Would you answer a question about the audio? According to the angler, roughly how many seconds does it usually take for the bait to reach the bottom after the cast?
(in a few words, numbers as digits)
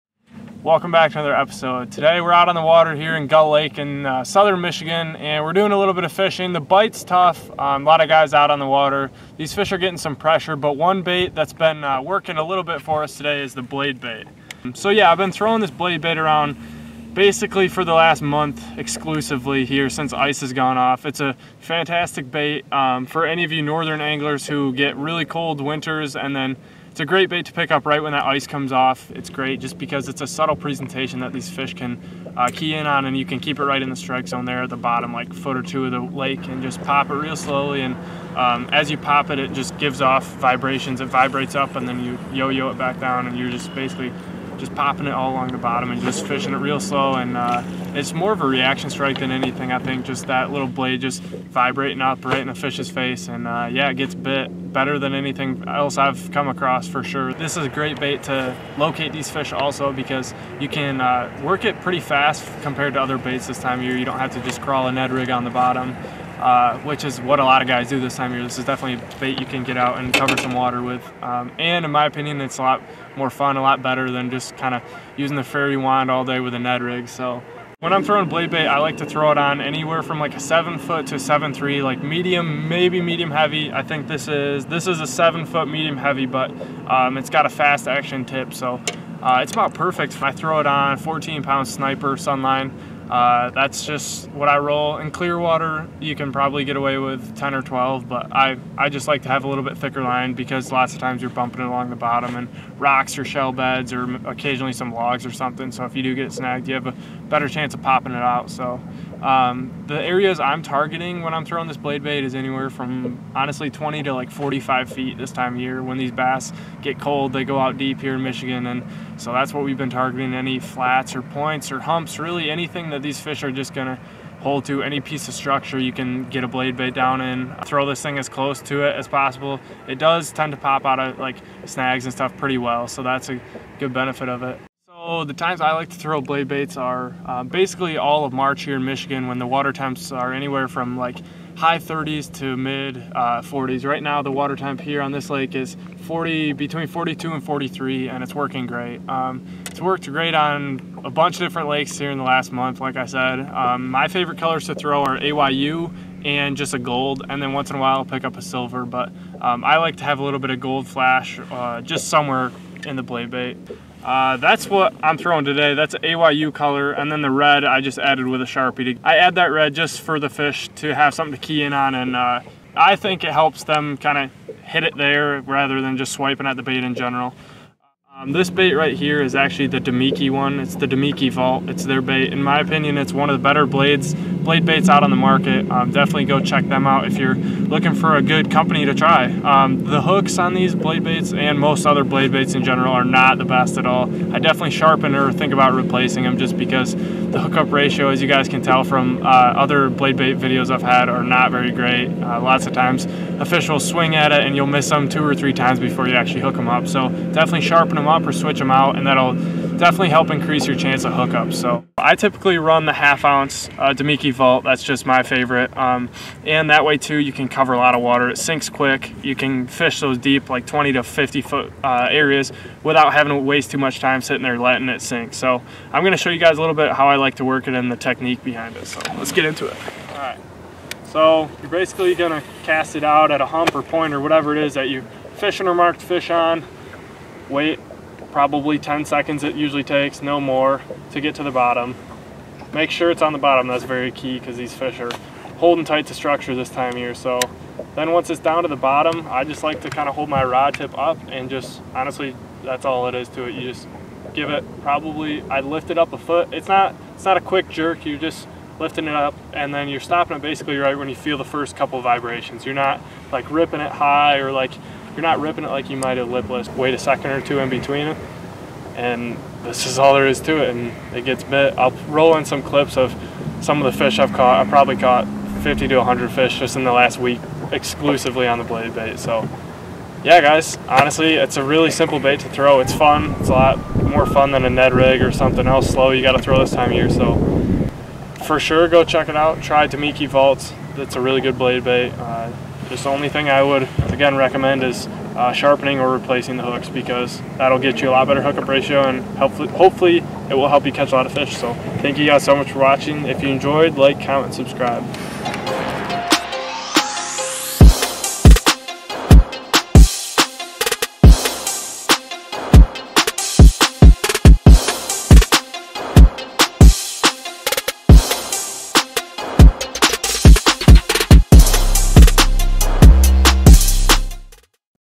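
10.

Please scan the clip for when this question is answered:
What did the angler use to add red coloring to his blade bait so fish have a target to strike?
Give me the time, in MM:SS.
02:48.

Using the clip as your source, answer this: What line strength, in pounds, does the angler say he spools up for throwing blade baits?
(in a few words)
14.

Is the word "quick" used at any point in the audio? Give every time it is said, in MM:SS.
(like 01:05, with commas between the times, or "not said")
03:38, 04:17.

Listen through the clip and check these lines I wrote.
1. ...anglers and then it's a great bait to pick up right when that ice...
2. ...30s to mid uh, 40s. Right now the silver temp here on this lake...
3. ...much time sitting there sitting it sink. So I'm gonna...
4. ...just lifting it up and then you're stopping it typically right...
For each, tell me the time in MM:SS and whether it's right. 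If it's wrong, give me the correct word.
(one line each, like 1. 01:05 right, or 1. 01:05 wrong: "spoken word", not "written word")
1. 00:25 wrong: "winters", not "anglers"
2. 02:21 wrong: "water", not "silver"
3. 03:43 wrong: "letting", not "sitting"
4. 04:18 wrong: "basically", not "typically".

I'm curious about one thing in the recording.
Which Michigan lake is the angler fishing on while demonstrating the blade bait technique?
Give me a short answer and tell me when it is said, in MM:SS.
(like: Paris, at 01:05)
Gull Lake, at 00:03.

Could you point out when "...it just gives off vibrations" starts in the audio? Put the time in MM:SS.
00:39.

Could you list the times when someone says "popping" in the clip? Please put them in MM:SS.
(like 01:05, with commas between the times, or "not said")
00:44, 01:47.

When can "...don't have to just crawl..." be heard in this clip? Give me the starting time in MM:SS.
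01:04.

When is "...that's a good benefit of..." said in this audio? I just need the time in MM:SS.
02:13.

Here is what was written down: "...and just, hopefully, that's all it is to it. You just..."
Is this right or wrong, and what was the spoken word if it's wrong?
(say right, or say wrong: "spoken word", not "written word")
wrong: "honestly", not "hopefully".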